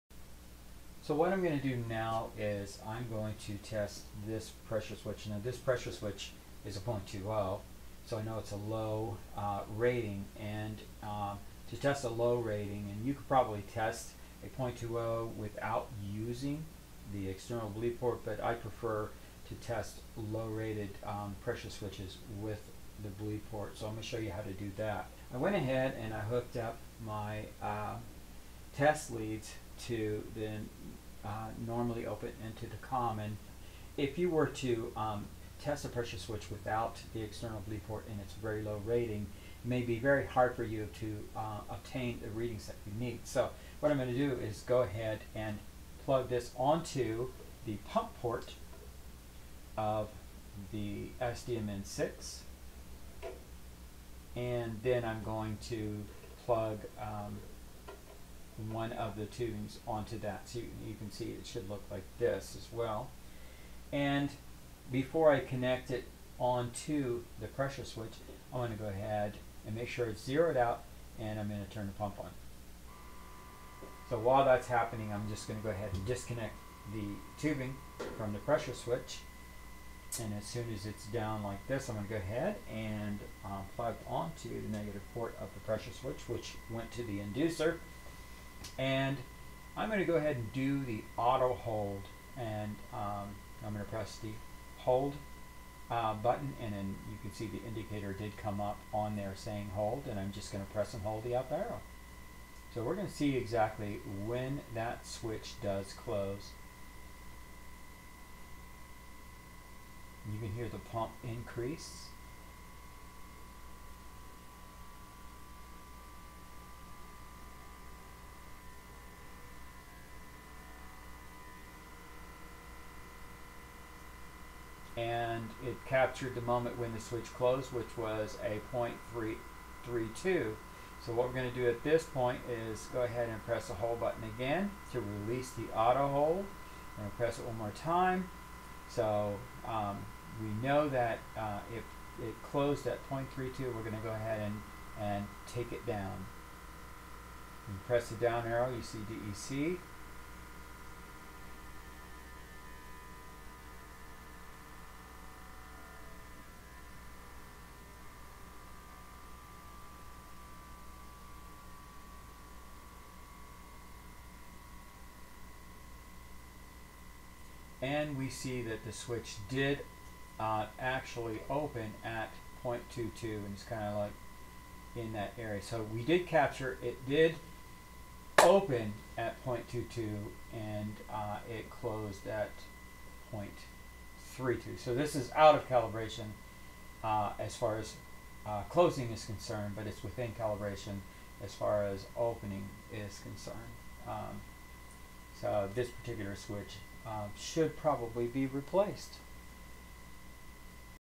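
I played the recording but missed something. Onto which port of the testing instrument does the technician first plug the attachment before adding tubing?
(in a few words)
pump port.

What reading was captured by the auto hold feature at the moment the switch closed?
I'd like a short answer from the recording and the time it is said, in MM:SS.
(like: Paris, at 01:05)
0.332, at 02:08.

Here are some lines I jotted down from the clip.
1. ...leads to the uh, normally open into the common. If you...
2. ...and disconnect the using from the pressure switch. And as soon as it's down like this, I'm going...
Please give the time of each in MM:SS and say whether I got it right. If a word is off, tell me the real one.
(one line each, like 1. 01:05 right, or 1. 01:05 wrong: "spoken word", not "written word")
1. 00:29 right
2. 01:15 wrong: "tubing", not "using".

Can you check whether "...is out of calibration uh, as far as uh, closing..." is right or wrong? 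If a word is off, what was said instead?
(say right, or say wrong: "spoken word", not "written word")
right.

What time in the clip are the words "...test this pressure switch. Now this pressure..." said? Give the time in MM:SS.
00:03.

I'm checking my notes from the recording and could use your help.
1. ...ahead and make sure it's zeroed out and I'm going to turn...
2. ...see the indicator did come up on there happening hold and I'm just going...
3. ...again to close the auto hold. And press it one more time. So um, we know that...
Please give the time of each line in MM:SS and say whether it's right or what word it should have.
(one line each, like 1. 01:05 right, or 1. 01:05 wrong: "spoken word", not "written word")
1. 01:08 right
2. 01:37 wrong: "saying", not "happening"
3. 02:14 wrong: "release", not "close".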